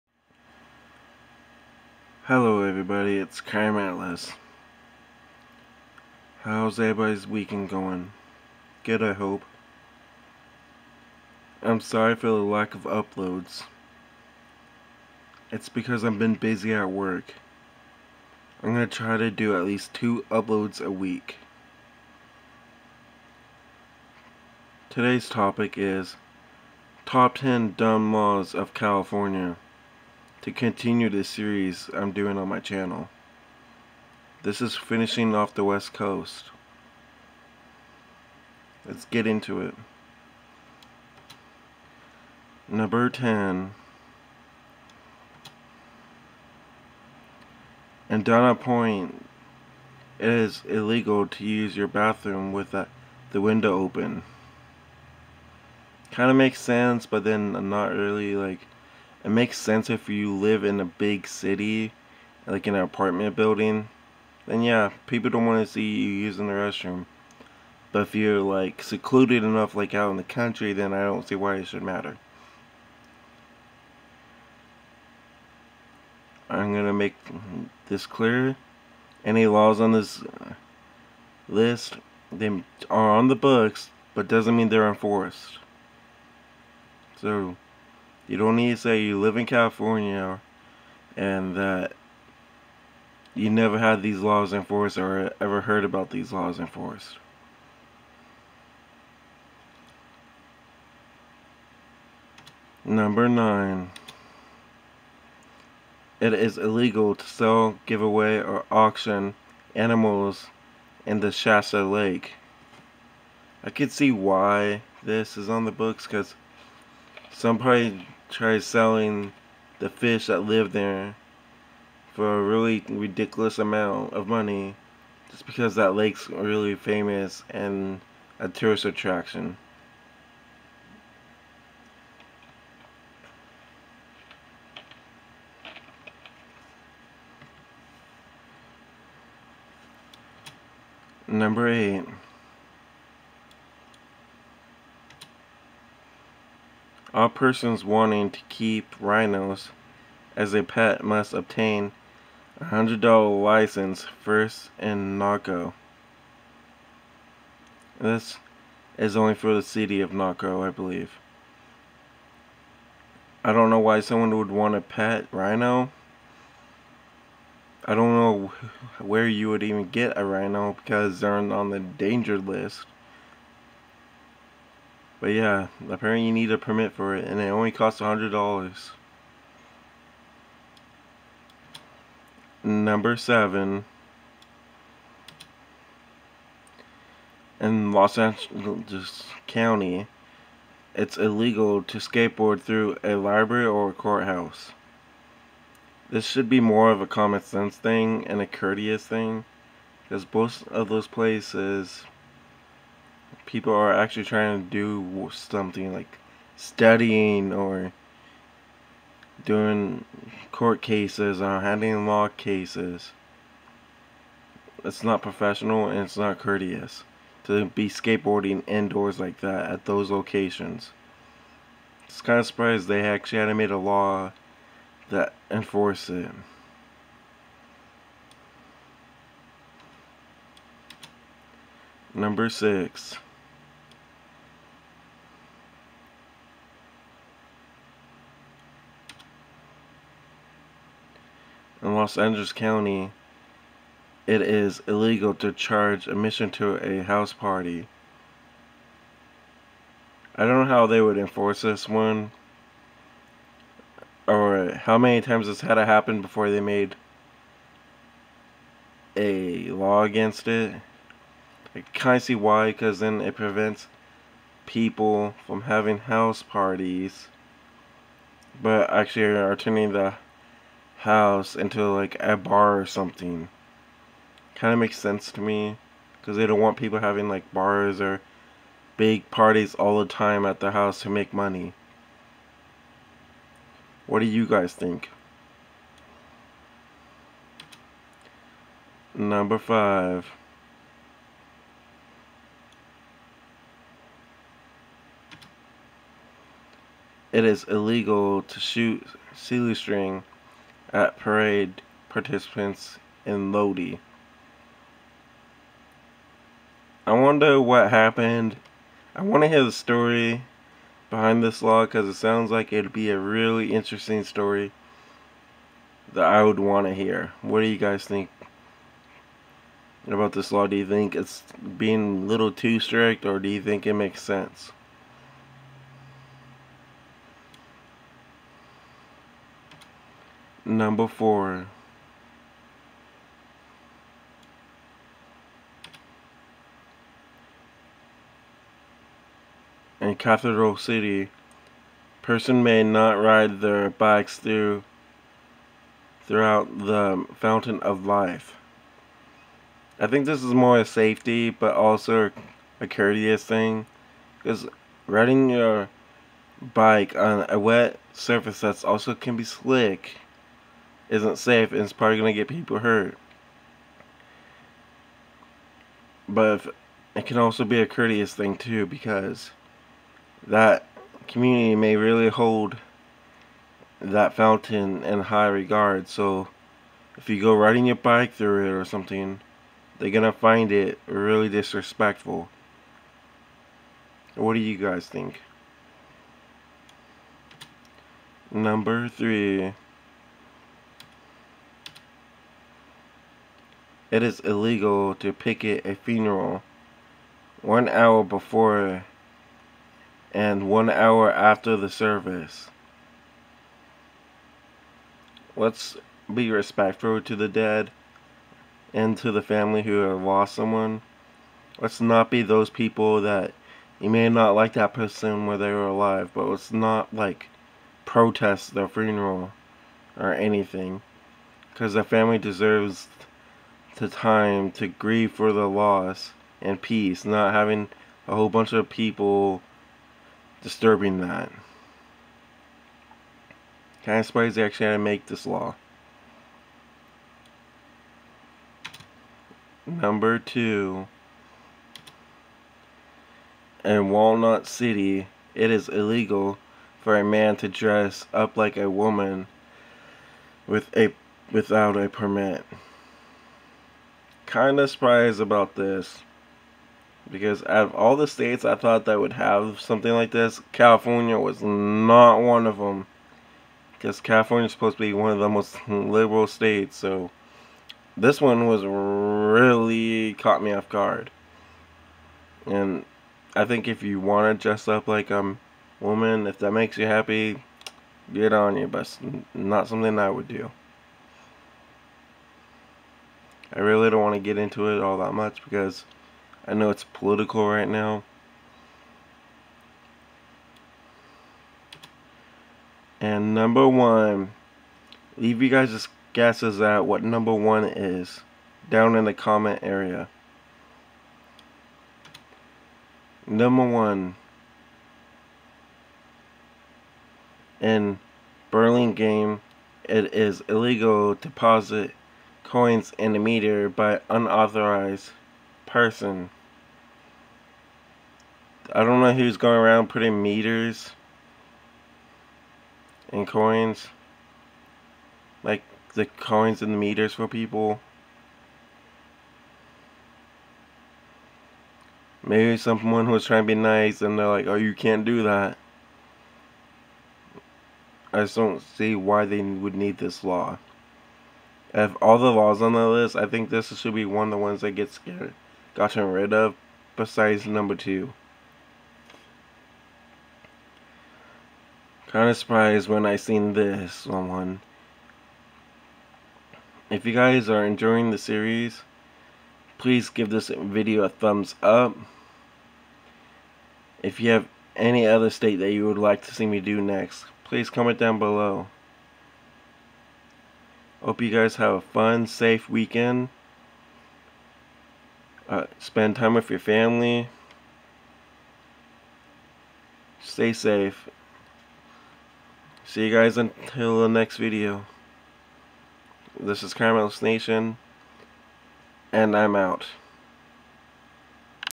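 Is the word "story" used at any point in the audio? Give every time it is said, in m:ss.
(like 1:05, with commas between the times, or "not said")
5:09, 5:14.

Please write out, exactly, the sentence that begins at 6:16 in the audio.
So if you go riding your bike through it or something, they're gonna find it really disrespectful.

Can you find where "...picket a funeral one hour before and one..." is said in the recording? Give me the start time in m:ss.
6:35.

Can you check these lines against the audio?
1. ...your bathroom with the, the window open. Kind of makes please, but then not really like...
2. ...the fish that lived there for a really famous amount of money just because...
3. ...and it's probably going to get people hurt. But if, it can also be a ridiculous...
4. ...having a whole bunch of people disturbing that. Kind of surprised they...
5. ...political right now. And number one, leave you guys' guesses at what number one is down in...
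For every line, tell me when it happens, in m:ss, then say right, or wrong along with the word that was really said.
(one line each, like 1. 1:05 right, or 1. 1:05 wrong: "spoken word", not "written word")
1. 0:51 wrong: "sense", not "please"
2. 1:59 wrong: "ridiculous", not "famous"
3. 6:01 wrong: "courteous", not "ridiculous"
4. 7:07 right
5. 8:07 right.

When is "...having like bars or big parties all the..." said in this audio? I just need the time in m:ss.
4:36.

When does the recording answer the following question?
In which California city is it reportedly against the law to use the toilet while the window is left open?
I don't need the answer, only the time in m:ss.
0:48.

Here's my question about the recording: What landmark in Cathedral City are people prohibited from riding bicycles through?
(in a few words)
the fountain of life.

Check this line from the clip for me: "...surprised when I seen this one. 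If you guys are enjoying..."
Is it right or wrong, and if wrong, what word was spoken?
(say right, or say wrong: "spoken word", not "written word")
right.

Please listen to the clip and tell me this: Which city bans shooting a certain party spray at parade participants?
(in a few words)
Lodi.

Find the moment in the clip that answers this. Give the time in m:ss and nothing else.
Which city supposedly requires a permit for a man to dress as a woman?
7:24.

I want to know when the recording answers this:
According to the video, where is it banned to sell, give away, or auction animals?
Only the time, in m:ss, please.
1:51.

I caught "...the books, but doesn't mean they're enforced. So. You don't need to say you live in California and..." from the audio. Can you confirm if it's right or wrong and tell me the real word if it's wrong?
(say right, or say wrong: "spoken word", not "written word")
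right.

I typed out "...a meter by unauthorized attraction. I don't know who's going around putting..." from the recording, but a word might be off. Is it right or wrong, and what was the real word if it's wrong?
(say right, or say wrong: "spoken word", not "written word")
wrong: "person", not "attraction".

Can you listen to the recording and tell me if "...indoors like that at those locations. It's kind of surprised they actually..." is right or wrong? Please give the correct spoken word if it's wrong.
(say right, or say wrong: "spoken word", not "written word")
right.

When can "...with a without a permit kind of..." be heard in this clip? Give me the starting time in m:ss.
7:30.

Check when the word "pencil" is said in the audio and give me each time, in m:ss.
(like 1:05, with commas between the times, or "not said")
not said.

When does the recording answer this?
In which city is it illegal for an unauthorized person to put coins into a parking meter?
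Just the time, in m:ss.
8:28.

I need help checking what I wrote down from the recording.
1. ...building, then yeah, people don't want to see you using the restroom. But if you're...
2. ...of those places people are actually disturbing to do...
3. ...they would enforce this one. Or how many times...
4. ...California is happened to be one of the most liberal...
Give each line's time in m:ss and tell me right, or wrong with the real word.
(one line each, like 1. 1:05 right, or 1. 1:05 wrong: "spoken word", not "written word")
1. 1:03 right
2. 3:20 wrong: "trying", not "disturbing"
3. 4:10 right
4. 7:44 wrong: "supposed", not "happened".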